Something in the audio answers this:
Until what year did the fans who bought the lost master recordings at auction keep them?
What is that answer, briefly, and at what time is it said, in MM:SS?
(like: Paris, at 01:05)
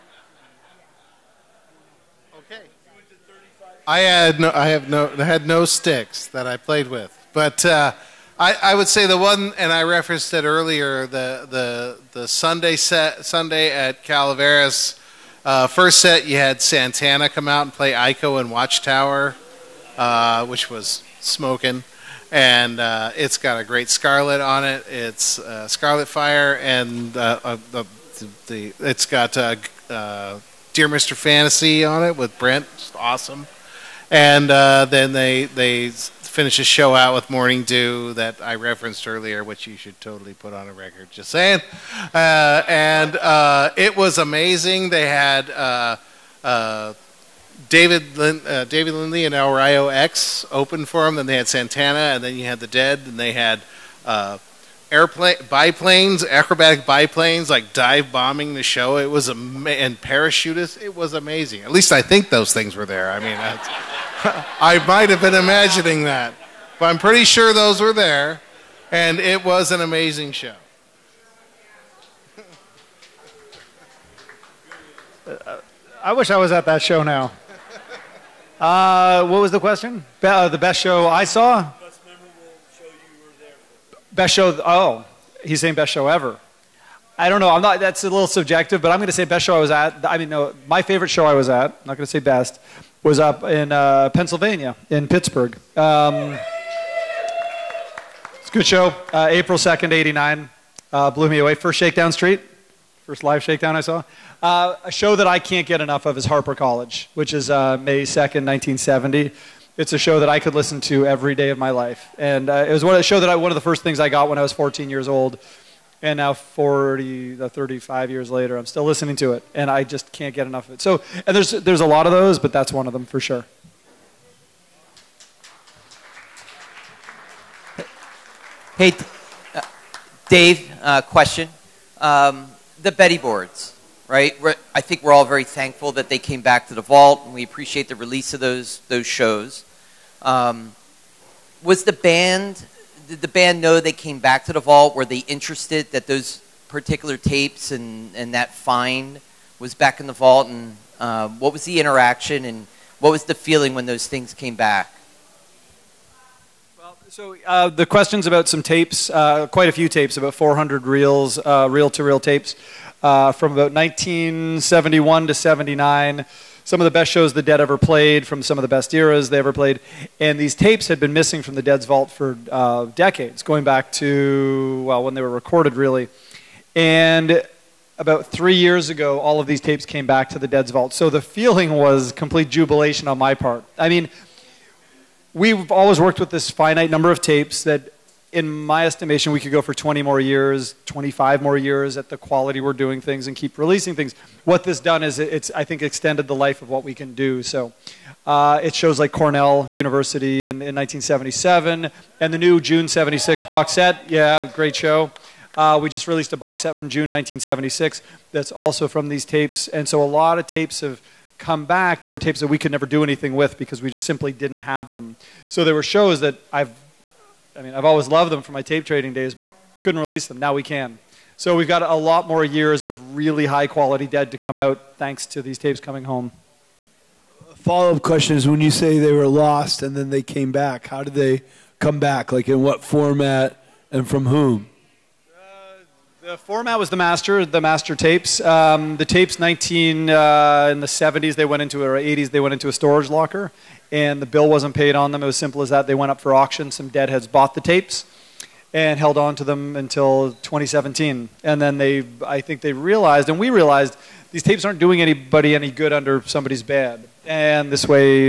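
2017, at 04:10.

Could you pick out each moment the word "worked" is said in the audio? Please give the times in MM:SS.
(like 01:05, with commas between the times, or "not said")
03:05.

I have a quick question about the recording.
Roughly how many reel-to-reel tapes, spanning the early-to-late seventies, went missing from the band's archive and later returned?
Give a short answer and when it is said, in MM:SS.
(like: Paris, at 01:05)
400, at 02:40.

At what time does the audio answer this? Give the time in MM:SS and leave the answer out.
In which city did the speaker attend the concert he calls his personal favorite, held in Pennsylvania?
01:35.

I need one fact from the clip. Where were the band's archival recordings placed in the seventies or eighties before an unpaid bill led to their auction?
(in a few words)
A storage locker.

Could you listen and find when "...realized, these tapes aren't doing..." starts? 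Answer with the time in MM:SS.
04:13.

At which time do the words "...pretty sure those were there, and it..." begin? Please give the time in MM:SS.
01:06.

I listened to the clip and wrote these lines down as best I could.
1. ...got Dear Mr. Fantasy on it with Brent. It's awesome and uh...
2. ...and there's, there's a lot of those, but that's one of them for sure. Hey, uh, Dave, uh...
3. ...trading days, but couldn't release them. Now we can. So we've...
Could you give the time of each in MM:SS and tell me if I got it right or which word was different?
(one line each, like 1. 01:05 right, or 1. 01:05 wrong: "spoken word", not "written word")
1. 00:29 right
2. 02:01 right
3. 03:38 right.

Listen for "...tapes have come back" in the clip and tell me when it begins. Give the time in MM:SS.
03:30.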